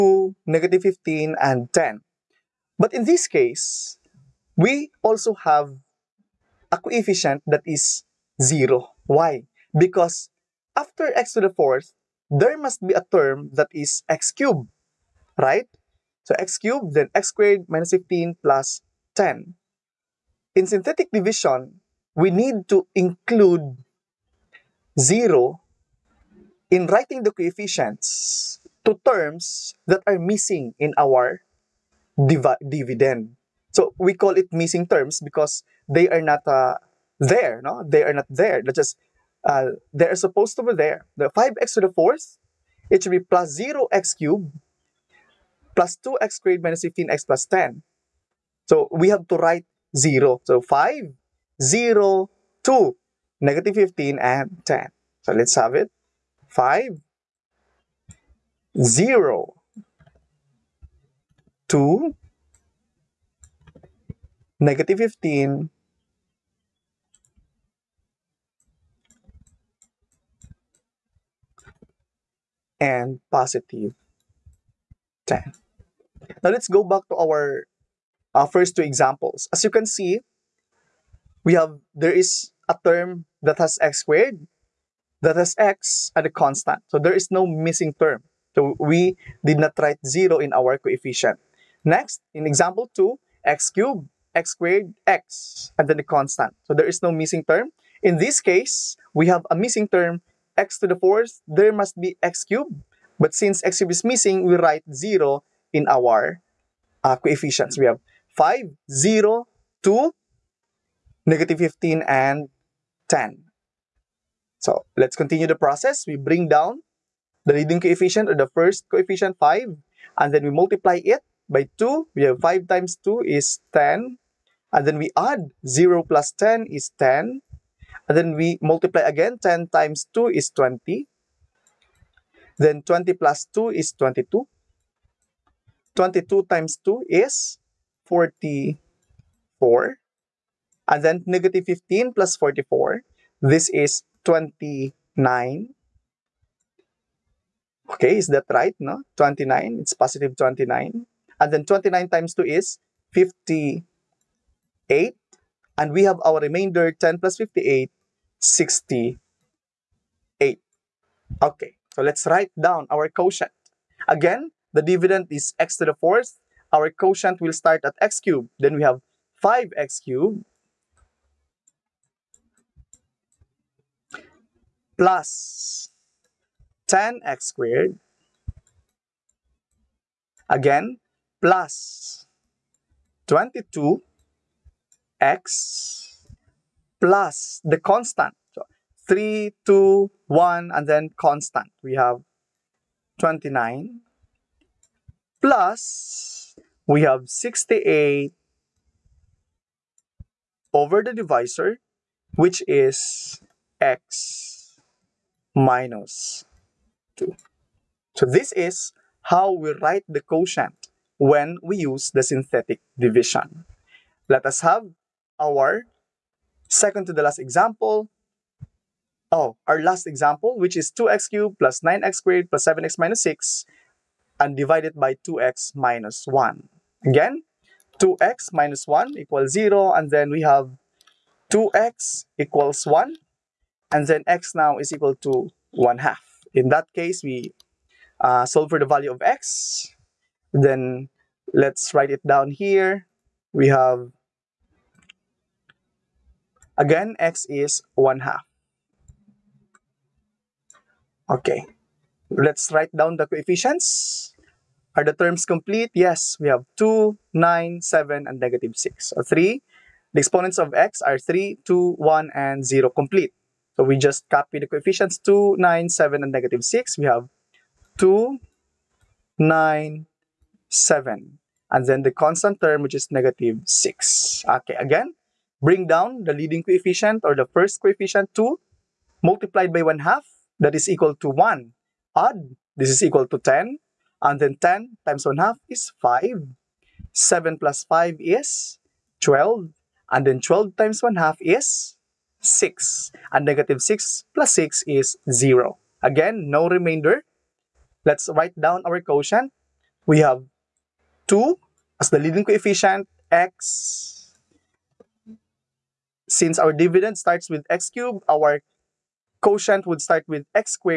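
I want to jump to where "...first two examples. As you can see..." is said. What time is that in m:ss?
1:18.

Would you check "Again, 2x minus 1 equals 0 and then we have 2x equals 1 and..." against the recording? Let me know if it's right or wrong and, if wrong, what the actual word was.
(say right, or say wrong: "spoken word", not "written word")
right.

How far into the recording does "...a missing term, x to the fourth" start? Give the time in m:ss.
1:39.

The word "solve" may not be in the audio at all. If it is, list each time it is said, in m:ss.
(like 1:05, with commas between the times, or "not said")
3:58.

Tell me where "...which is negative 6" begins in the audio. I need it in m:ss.
4:32.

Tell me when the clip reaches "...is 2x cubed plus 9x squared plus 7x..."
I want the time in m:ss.
3:40.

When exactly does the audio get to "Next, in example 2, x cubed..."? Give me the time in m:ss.
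1:31.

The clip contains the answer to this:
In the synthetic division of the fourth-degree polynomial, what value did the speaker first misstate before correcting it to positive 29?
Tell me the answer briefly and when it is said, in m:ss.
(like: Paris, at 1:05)
-15 plus 44, at 2:21.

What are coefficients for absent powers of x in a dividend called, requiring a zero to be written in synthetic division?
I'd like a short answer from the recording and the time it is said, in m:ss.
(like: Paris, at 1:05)
missing terms, at 0:34.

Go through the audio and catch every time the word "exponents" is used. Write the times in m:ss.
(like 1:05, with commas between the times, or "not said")
4:20.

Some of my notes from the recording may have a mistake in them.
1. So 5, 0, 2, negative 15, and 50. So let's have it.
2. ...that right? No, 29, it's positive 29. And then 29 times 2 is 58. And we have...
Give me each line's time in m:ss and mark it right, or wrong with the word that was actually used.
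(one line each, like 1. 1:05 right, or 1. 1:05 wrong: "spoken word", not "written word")
1. 0:50 wrong: "10", not "50"
2. 2:28 right.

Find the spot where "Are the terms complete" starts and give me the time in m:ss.
4:14.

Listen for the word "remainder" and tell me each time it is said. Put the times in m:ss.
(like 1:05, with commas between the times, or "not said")
2:36, 4:56.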